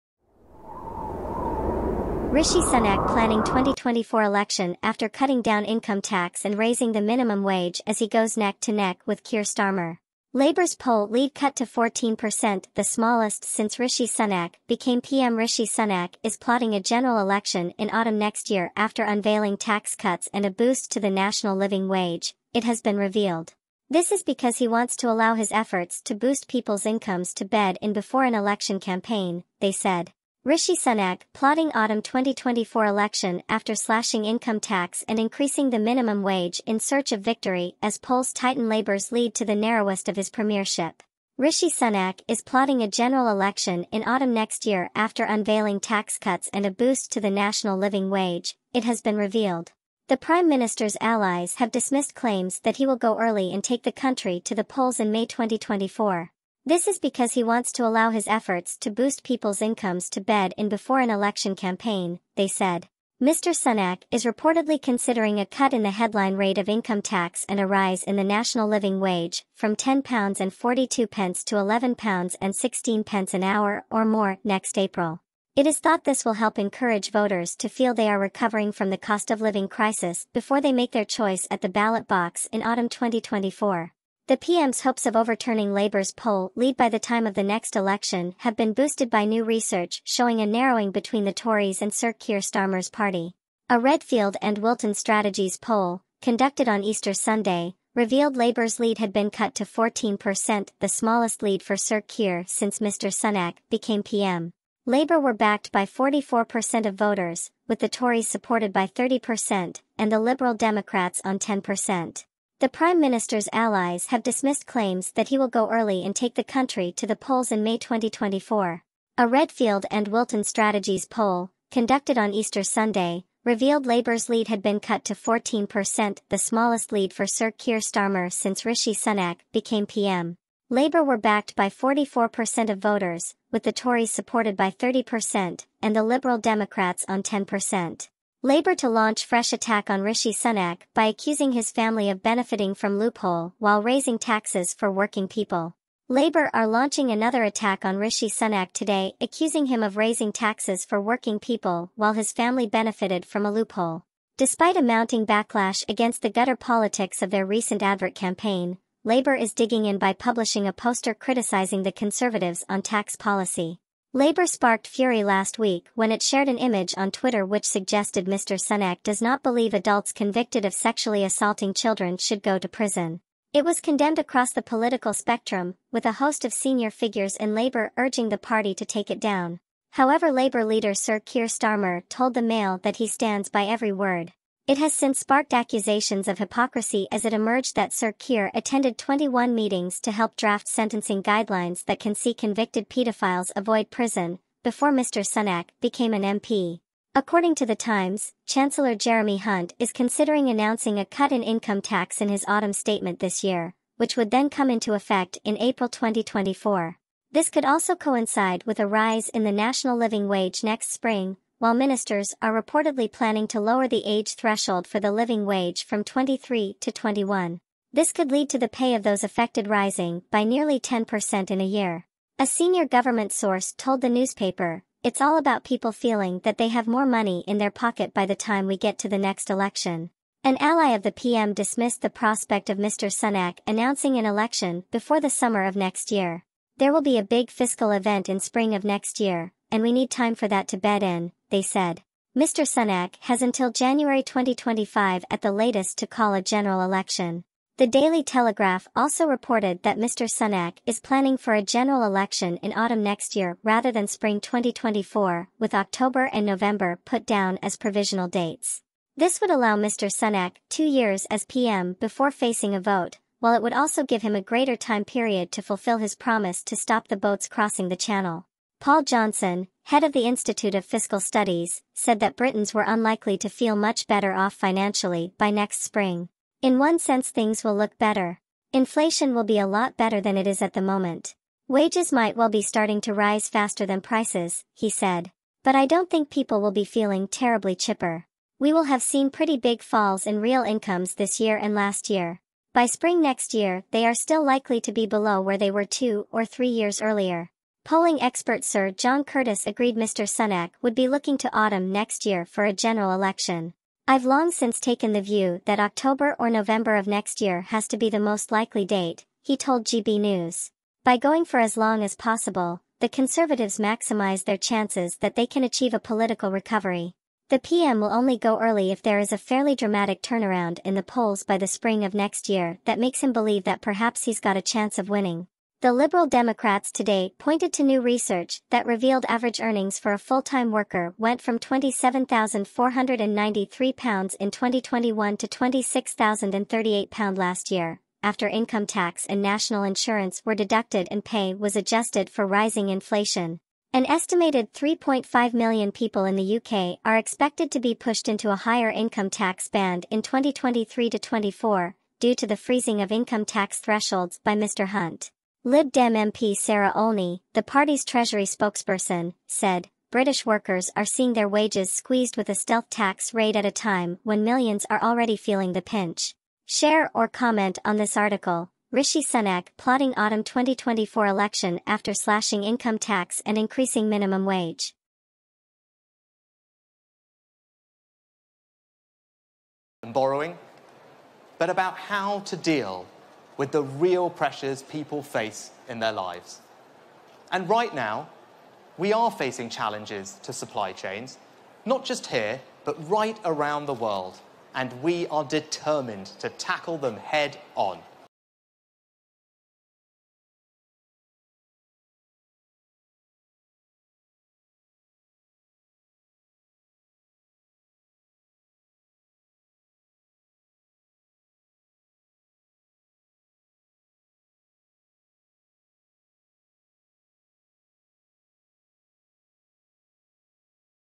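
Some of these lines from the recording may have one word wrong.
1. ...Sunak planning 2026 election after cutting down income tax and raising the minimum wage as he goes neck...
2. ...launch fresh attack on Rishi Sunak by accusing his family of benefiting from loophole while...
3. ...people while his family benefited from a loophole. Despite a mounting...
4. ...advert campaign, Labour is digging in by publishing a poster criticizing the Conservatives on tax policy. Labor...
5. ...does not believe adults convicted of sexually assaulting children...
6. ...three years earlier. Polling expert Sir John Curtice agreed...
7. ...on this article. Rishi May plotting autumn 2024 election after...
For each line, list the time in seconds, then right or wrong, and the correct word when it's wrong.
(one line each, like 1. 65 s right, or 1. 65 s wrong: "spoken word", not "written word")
1. 2 s wrong: "2024", not "2026"
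2. 138 s right
3. 151 s right
4. 157 s right
5. 169 s right
6. 296 s right
7. 367 s wrong: "Sunak", not "May".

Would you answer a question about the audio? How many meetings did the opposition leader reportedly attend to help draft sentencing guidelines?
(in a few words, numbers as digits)
21.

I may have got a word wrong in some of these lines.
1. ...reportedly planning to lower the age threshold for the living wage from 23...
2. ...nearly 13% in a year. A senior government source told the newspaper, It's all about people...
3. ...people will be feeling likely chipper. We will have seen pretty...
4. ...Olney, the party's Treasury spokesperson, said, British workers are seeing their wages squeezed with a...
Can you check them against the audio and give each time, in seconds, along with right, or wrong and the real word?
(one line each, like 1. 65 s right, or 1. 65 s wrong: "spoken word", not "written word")
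1. 212 s right
2. 220 s wrong: "10", not "13"
3. 286 s wrong: "terribly", not "likely"
4. 356 s right.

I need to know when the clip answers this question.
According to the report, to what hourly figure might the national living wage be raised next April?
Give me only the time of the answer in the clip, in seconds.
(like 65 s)
71 s.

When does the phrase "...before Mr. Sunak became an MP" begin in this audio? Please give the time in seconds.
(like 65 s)
194 s.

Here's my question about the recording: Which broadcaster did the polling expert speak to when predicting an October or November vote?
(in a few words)
GB News.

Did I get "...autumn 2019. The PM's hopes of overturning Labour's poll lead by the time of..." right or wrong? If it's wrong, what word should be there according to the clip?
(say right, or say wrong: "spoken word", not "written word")
wrong: "2024", not "2019".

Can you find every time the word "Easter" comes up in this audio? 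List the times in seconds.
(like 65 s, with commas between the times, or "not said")
96 s, 122 s.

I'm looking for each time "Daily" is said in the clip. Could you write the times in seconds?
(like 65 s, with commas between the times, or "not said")
247 s.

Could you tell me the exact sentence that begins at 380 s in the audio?
Borrowing, but about how to deal with the real pressures people face in their lives.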